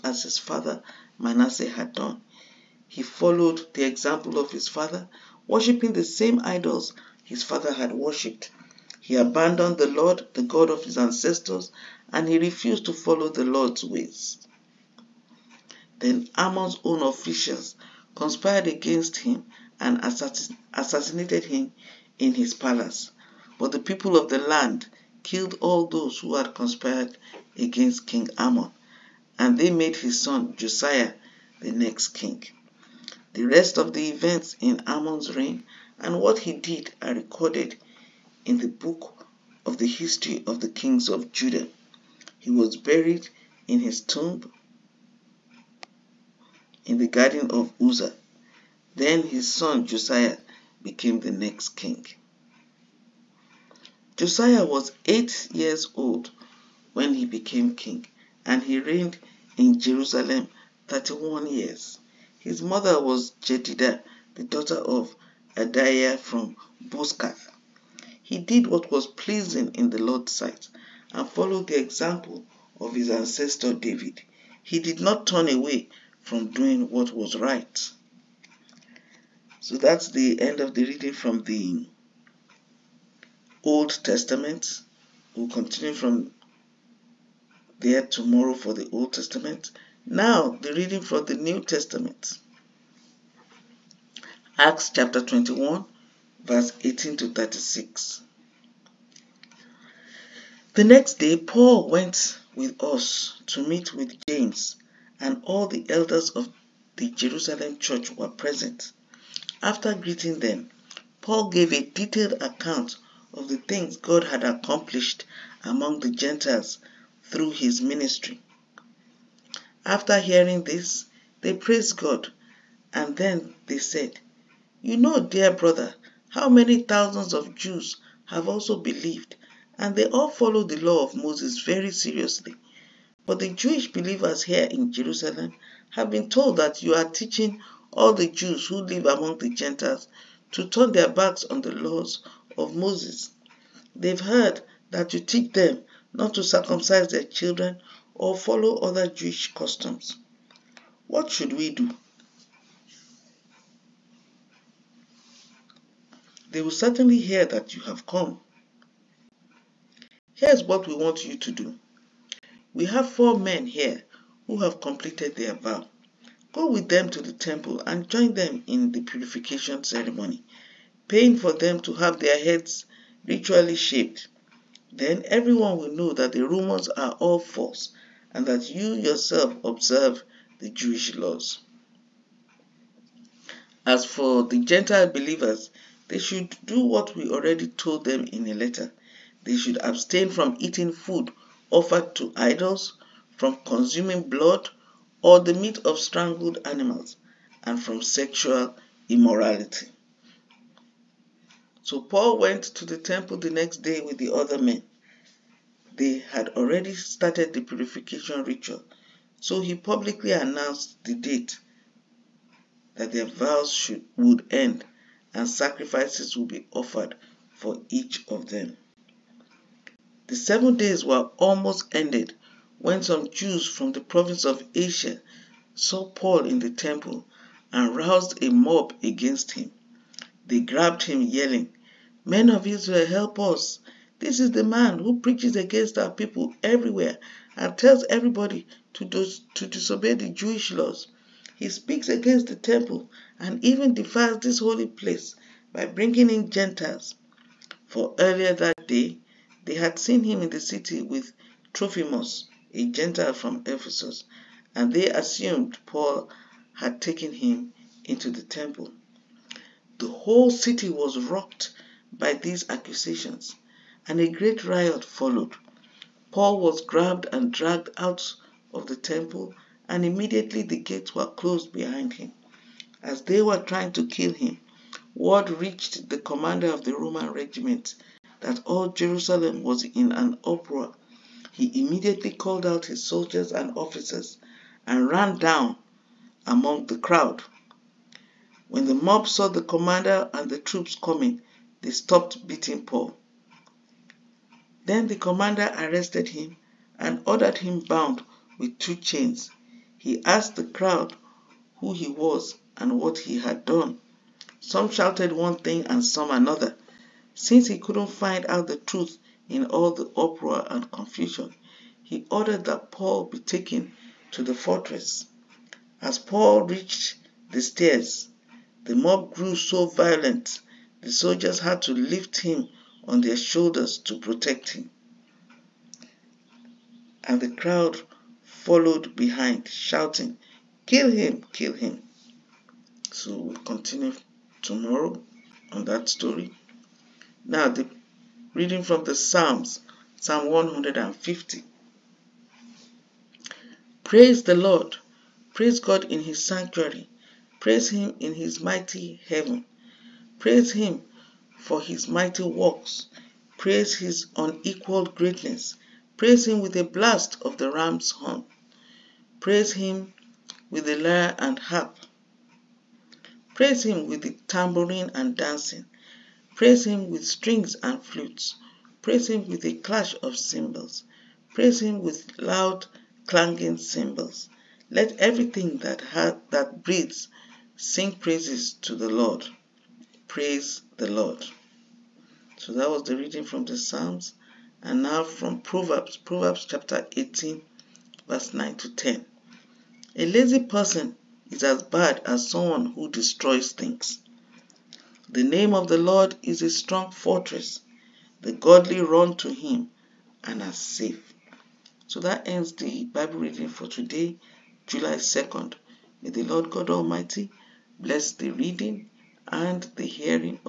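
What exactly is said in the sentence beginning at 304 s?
Some shouted one thing and some another.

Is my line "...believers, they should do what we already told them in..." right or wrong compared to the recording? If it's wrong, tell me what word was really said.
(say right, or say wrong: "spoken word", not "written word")
right.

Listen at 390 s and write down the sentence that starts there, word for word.
A lazy person is as bad as someone who destroys things.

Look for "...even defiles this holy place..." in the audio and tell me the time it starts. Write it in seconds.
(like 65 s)
243 s.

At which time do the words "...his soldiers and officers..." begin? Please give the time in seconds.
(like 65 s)
282 s.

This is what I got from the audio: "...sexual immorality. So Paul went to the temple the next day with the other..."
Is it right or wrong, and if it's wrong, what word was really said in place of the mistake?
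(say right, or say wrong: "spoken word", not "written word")
right.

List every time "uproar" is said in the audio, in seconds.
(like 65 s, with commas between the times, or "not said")
280 s, 310 s.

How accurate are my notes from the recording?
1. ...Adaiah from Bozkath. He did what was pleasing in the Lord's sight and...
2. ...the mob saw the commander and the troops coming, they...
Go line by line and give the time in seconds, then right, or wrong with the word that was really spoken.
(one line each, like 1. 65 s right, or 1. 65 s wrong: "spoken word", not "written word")
1. 65 s right
2. 288 s right.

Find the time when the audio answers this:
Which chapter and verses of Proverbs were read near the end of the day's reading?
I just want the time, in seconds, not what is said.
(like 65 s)
386 s.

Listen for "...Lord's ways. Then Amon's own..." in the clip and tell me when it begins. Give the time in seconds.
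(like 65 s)
13 s.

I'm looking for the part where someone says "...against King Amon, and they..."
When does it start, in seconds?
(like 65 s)
27 s.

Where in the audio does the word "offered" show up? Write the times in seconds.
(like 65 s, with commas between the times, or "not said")
191 s, 216 s.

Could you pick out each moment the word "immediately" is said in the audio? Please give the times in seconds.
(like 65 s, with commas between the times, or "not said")
270 s, 281 s.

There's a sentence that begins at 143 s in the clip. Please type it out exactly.
They've heard that you teach them not to circumcise their children or follow other Jewish customs.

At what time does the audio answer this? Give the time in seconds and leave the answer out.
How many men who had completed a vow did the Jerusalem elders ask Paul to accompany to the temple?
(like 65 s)
163 s.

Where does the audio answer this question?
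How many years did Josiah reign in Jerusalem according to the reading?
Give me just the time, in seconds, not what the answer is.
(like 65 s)
60 s.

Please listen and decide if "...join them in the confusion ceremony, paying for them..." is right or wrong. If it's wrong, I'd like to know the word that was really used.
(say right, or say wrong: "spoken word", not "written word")
wrong: "purification", not "confusion".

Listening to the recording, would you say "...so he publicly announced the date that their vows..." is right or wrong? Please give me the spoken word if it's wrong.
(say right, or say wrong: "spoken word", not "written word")
right.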